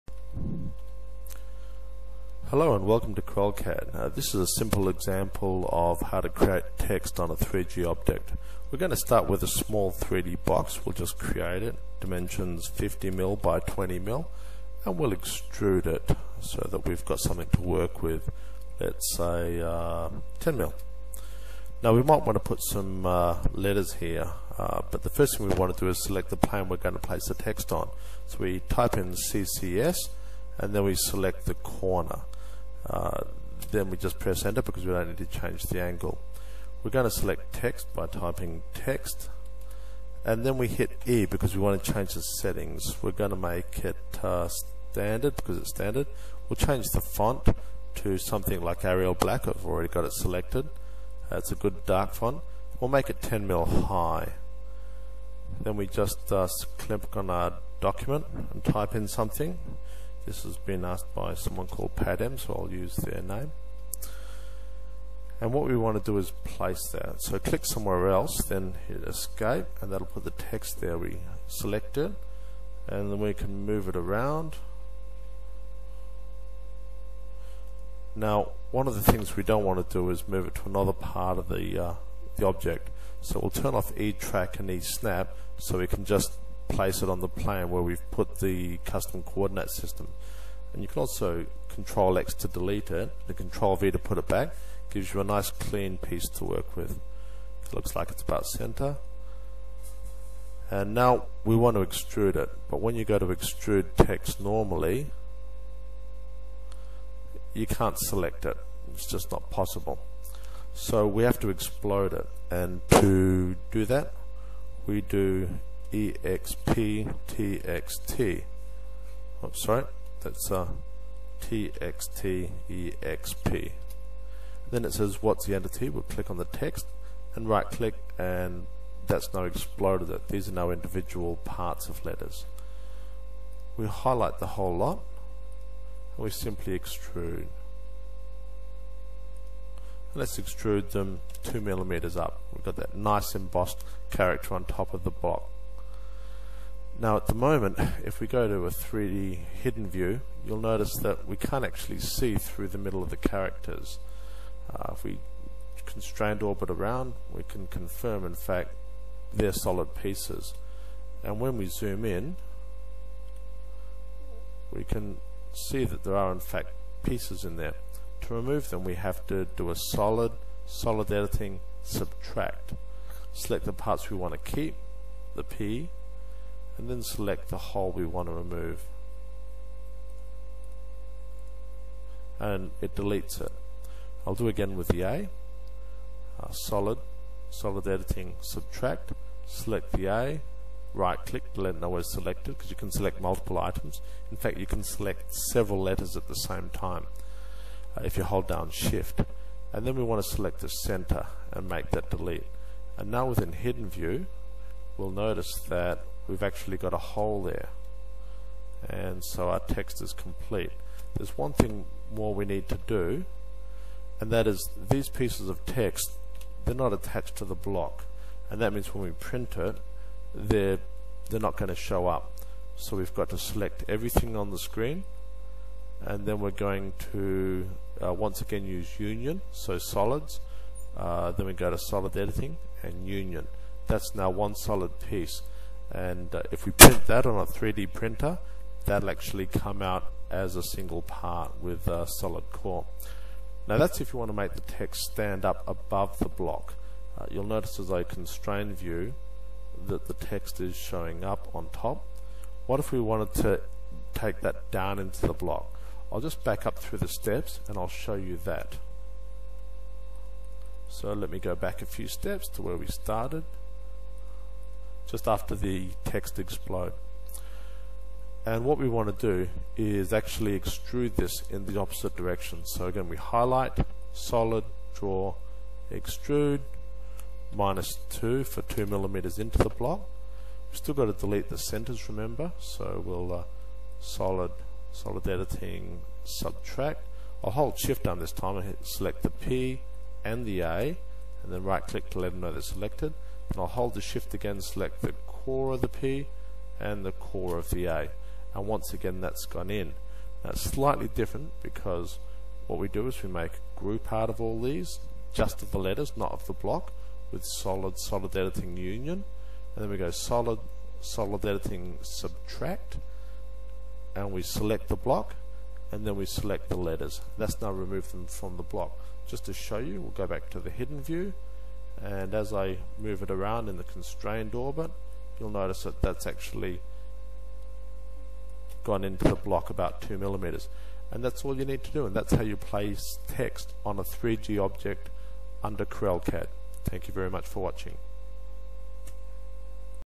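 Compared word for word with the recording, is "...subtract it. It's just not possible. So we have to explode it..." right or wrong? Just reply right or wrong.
wrong.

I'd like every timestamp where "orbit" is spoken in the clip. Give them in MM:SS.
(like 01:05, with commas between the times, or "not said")
02:36, 05:24.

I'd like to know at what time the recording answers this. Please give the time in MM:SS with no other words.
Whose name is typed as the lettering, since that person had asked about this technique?
01:01.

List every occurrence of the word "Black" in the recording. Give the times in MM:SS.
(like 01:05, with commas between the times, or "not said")
00:49.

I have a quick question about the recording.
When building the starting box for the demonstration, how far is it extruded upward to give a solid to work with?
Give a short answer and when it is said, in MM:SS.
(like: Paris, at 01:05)
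10mm, at 00:20.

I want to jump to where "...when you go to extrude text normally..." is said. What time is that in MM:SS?
01:42.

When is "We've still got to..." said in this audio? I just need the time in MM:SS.
04:40.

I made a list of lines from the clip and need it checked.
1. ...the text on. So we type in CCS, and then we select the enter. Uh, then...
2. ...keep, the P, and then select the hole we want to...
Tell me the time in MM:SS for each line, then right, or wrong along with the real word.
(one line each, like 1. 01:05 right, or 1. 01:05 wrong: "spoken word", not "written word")
1. 00:27 wrong: "corner", not "enter"
2. 02:54 right.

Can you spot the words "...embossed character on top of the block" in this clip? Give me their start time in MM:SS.
02:23.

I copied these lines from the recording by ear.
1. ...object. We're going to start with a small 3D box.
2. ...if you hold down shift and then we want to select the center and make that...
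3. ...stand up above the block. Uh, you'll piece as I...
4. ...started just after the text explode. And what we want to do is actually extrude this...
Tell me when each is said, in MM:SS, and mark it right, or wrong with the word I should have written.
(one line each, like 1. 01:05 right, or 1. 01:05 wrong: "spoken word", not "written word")
1. 00:07 right
2. 03:18 right
3. 04:05 wrong: "notice", not "piece"
4. 04:22 right.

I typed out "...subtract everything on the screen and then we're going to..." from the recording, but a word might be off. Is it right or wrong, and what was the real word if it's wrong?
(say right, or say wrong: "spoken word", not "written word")
wrong: "select", not "subtract".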